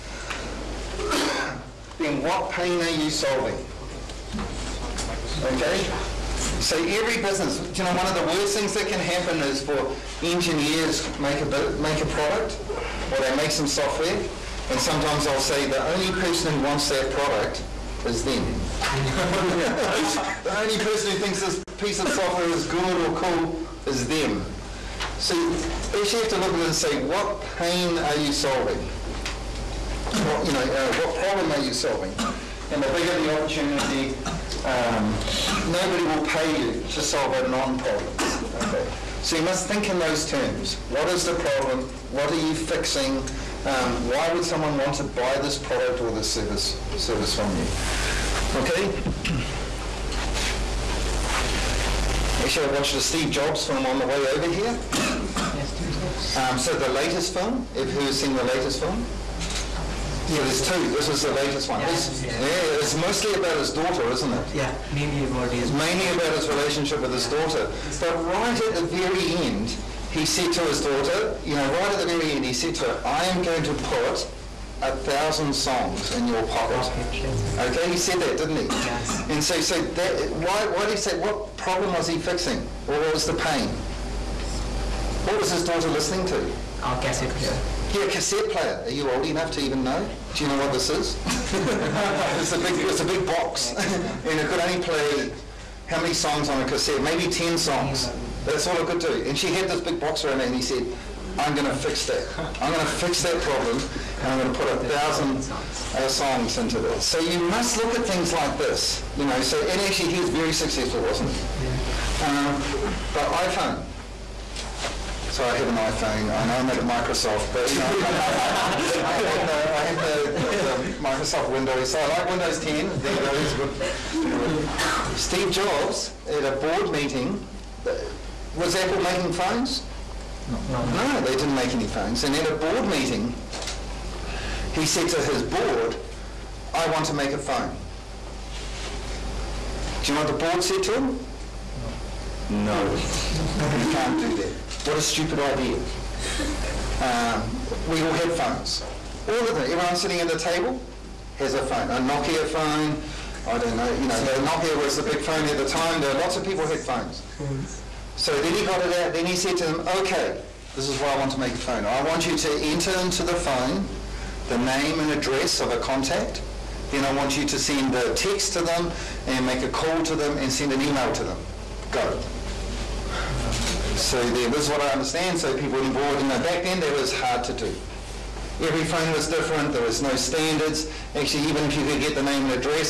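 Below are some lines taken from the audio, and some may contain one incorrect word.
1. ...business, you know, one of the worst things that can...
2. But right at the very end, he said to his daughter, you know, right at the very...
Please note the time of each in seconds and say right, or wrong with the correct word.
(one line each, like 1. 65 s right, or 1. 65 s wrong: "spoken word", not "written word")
1. 7 s right
2. 67 s right.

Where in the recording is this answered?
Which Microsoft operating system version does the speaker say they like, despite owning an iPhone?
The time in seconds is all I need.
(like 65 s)
122 s.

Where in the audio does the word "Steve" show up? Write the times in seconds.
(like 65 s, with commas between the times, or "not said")
52 s, 125 s.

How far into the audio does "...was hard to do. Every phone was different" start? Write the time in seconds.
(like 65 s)
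176 s.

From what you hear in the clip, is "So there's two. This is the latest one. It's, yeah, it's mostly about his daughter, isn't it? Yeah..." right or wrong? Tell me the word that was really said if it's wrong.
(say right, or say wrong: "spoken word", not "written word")
right.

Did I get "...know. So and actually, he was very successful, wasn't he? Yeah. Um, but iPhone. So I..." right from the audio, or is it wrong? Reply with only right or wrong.
right.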